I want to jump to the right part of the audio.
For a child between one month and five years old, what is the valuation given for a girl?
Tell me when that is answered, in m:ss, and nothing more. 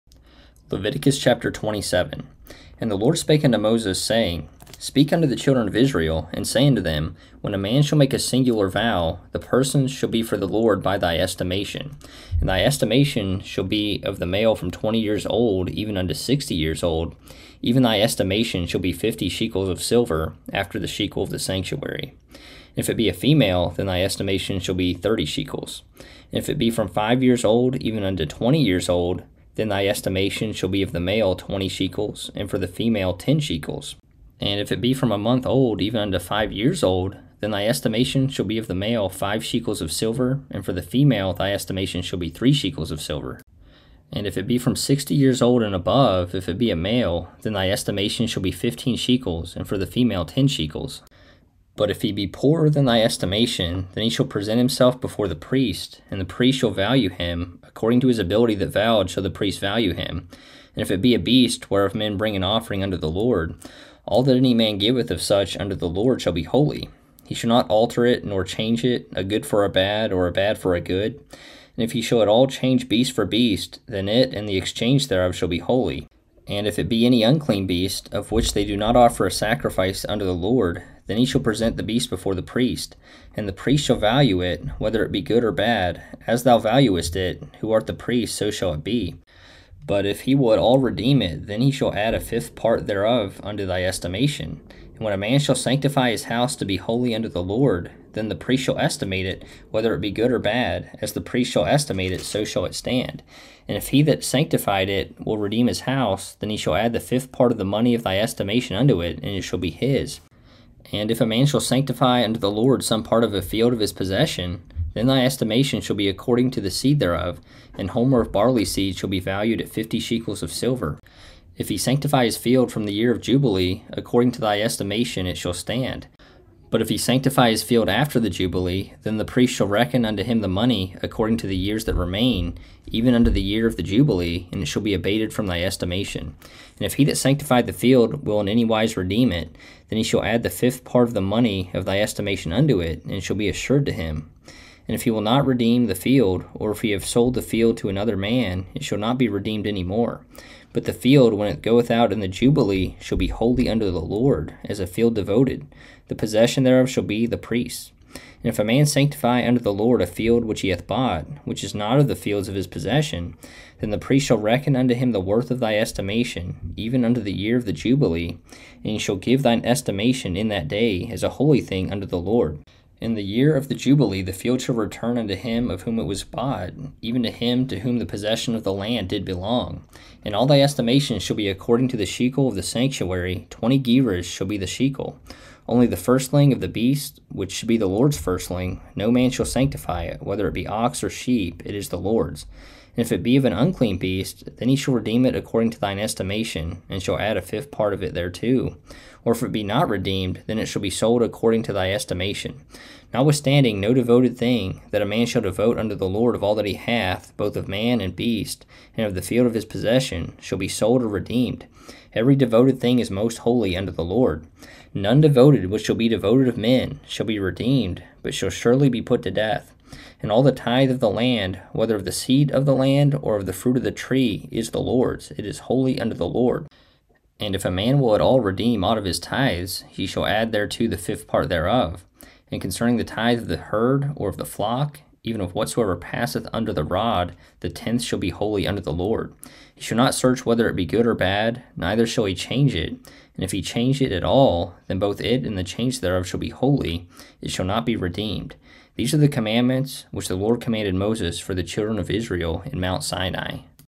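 0:42.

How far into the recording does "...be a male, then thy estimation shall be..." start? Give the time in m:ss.
0:46.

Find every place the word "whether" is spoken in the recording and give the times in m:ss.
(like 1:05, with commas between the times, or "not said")
1:24, 1:39, 3:10, 3:41, 4:00.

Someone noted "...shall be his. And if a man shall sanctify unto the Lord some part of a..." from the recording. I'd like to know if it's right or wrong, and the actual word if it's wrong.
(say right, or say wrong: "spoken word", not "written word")
right.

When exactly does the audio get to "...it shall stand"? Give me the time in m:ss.
2:05.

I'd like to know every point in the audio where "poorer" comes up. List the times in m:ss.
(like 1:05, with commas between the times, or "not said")
0:52.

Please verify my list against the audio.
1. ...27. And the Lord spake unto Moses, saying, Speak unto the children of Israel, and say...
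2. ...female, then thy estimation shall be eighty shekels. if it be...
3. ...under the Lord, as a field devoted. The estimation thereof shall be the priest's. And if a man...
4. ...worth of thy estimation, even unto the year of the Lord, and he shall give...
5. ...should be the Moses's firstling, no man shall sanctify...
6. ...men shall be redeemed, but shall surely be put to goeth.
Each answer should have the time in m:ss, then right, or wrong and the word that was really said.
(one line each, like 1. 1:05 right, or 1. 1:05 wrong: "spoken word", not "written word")
1. 0:01 right
2. 0:23 wrong: "thirty", not "eighty"
3. 2:33 wrong: "possession", not "estimation"
4. 2:45 wrong: "Jubilee", not "Lord"
5. 3:07 wrong: "Lord", not "Moses"
6. 3:36 wrong: "death", not "goeth".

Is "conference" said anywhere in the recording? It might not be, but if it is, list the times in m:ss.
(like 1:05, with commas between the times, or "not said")
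not said.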